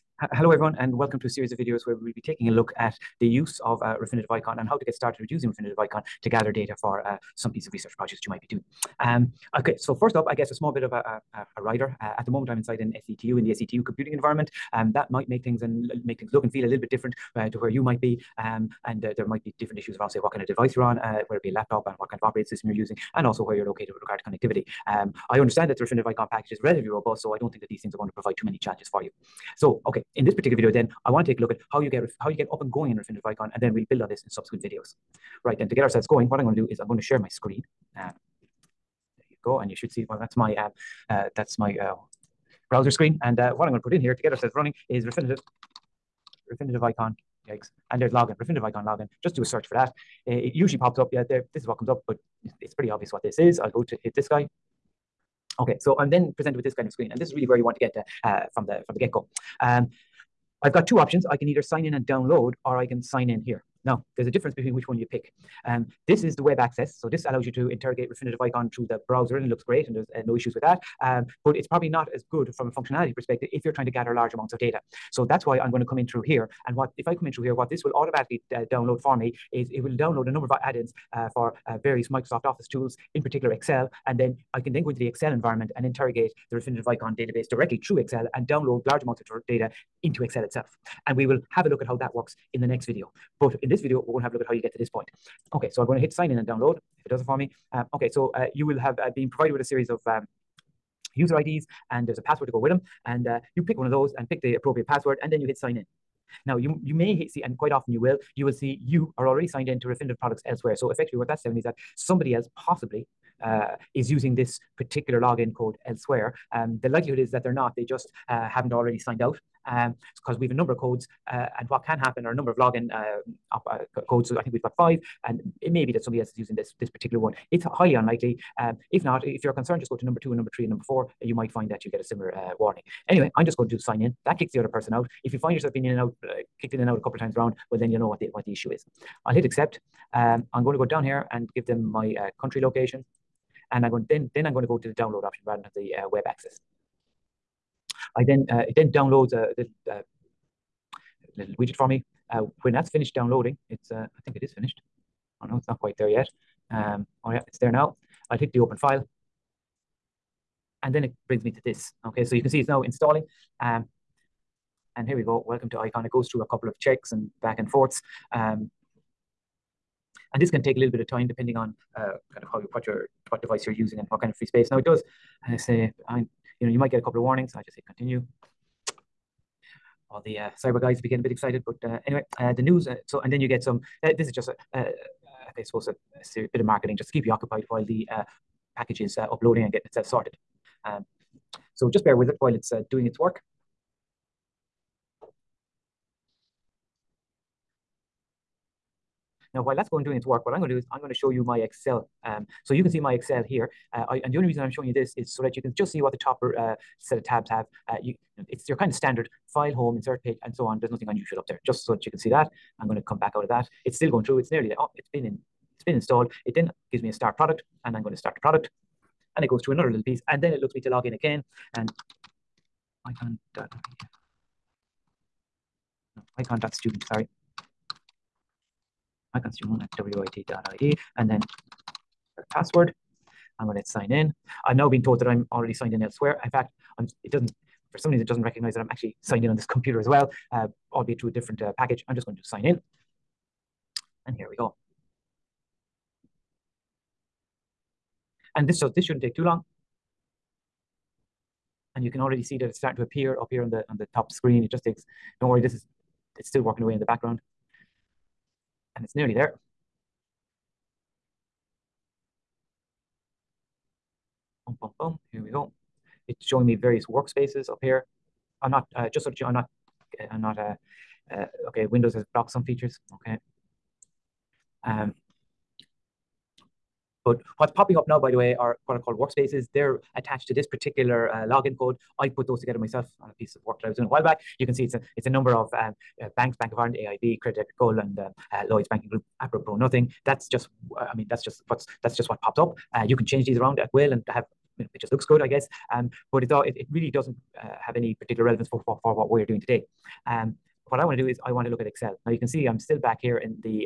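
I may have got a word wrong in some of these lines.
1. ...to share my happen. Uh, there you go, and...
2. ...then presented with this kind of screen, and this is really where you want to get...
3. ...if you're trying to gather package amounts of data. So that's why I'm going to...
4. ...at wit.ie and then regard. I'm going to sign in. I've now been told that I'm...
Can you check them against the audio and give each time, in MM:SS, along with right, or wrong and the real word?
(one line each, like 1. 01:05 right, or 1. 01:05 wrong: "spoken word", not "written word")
1. 00:36 wrong: "screen", not "happen"
2. 00:56 right
3. 01:13 wrong: "large", not "package"
4. 03:49 wrong: "password", not "regard".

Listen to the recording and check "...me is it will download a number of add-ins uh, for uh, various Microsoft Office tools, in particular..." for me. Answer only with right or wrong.
right.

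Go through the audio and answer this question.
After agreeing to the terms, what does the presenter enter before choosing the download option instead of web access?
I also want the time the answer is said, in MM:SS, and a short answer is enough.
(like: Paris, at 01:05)
Country location, at 02:22.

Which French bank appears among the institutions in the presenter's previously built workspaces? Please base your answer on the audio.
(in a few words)
Credit Agricole.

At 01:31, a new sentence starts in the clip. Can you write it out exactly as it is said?
And we will have a look at how that works in the next video.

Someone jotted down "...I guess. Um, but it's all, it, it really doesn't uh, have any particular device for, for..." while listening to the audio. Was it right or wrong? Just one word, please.
wrong.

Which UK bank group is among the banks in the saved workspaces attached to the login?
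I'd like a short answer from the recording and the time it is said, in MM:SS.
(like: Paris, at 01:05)
Lloyd's Banking Group, at 04:48.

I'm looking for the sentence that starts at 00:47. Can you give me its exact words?
Yikes and there's login, Refinitiv Eikon login.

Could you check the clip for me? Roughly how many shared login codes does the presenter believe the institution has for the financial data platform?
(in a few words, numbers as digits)
5.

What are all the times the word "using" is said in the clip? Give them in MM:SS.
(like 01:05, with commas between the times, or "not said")
00:05, 00:22, 01:54, 02:06, 02:53.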